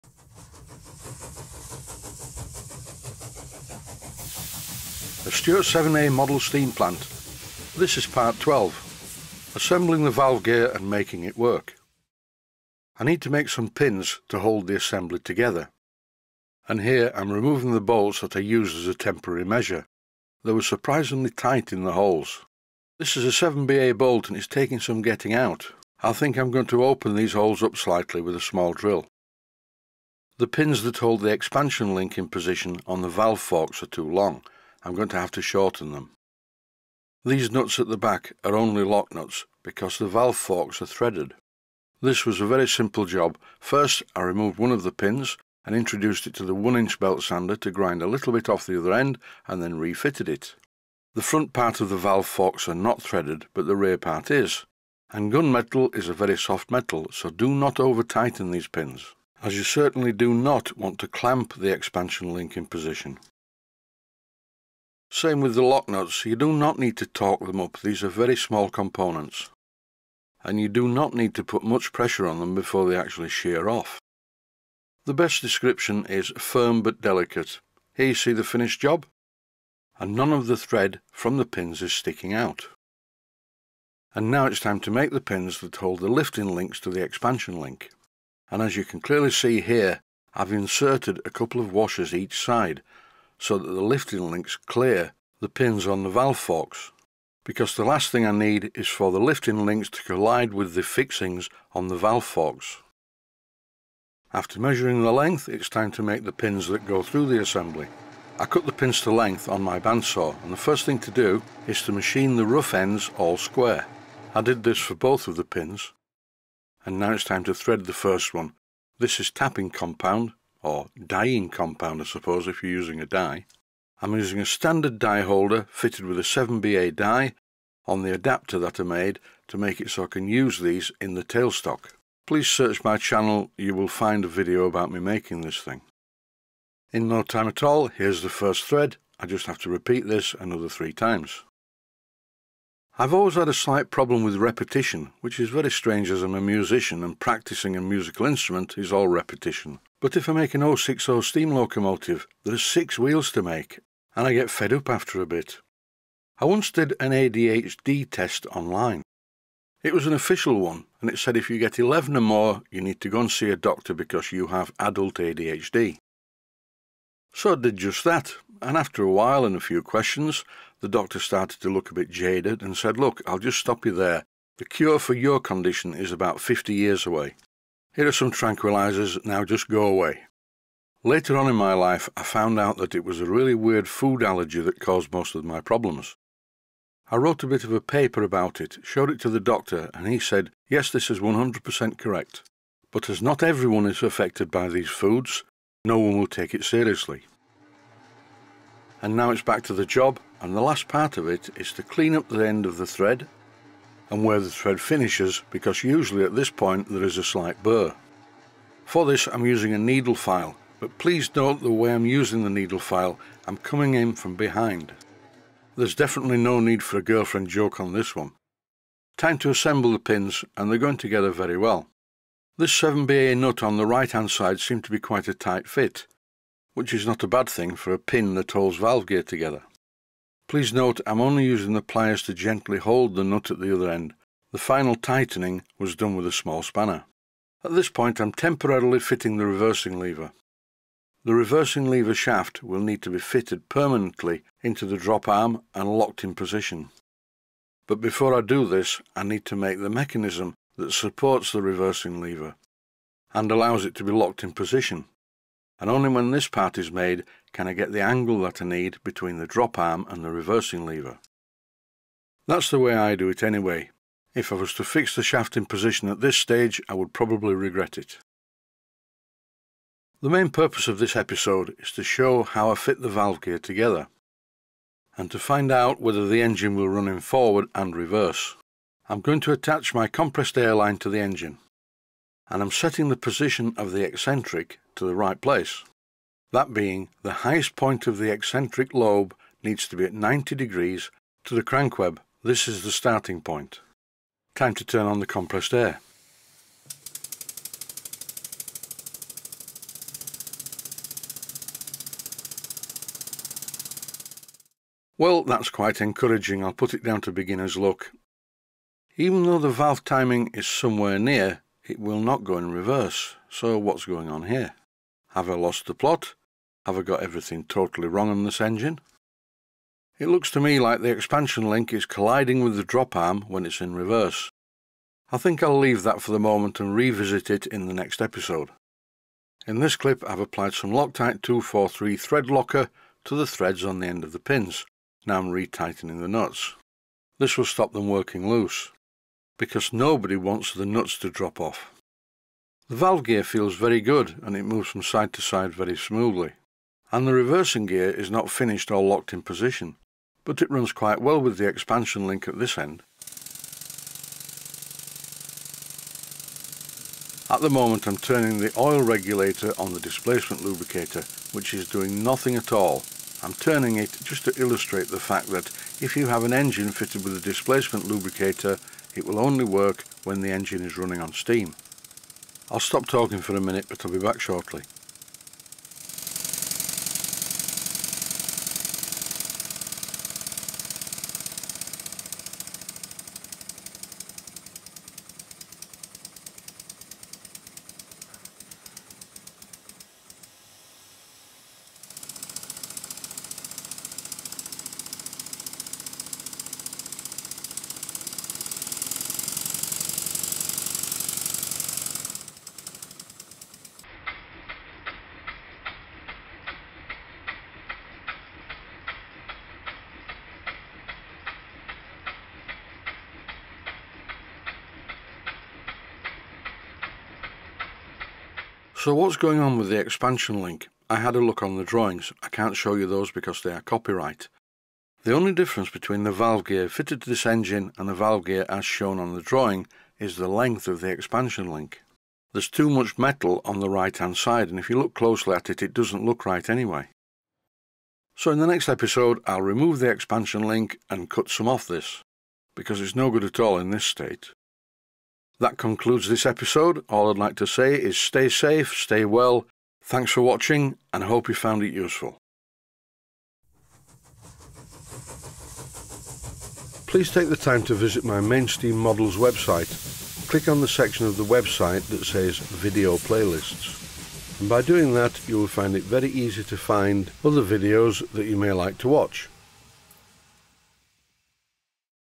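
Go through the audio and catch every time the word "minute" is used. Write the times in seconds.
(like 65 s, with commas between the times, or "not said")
373 s.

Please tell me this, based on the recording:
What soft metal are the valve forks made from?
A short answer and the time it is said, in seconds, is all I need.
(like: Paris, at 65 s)
Gunmetal, at 55 s.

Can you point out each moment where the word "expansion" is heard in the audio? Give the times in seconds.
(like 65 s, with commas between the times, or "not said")
31 s, 61 s, 87 s, 321 s, 351 s, 419 s, 431 s, 440 s.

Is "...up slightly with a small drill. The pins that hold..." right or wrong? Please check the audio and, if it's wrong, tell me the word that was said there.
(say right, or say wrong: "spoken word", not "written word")
right.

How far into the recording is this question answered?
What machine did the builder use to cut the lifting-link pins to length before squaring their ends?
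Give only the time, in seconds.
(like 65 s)
109 s.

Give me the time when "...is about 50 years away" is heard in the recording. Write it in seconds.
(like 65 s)
175 s.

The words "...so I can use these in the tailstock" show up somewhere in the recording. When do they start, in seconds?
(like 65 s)
129 s.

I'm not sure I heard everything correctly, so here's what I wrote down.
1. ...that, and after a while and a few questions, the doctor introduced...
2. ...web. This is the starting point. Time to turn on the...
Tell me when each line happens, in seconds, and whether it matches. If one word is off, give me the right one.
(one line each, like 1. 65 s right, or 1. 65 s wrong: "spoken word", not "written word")
1. 168 s wrong: "started", not "introduced"
2. 291 s right.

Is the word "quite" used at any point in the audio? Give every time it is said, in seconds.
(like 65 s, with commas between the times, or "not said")
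224 s, 305 s, 350 s.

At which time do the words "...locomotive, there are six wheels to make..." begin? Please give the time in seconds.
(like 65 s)
151 s.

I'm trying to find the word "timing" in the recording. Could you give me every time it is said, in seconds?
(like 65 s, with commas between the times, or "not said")
310 s.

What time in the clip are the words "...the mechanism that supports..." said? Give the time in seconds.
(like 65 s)
249 s.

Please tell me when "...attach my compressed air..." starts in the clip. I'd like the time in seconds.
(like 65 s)
279 s.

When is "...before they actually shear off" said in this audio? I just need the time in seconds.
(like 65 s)
72 s.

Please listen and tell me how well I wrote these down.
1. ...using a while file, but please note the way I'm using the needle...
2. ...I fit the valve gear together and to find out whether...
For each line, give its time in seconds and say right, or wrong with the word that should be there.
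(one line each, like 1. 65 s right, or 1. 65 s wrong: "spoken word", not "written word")
1. 209 s wrong: "needle", not "while"
2. 272 s right.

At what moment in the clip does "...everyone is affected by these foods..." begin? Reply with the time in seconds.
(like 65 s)
193 s.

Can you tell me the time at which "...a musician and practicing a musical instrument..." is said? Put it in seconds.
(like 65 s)
146 s.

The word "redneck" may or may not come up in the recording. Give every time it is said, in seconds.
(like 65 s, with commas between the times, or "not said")
not said.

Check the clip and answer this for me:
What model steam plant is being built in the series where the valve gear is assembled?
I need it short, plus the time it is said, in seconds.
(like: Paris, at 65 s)
Stuart 7A, at 5 s.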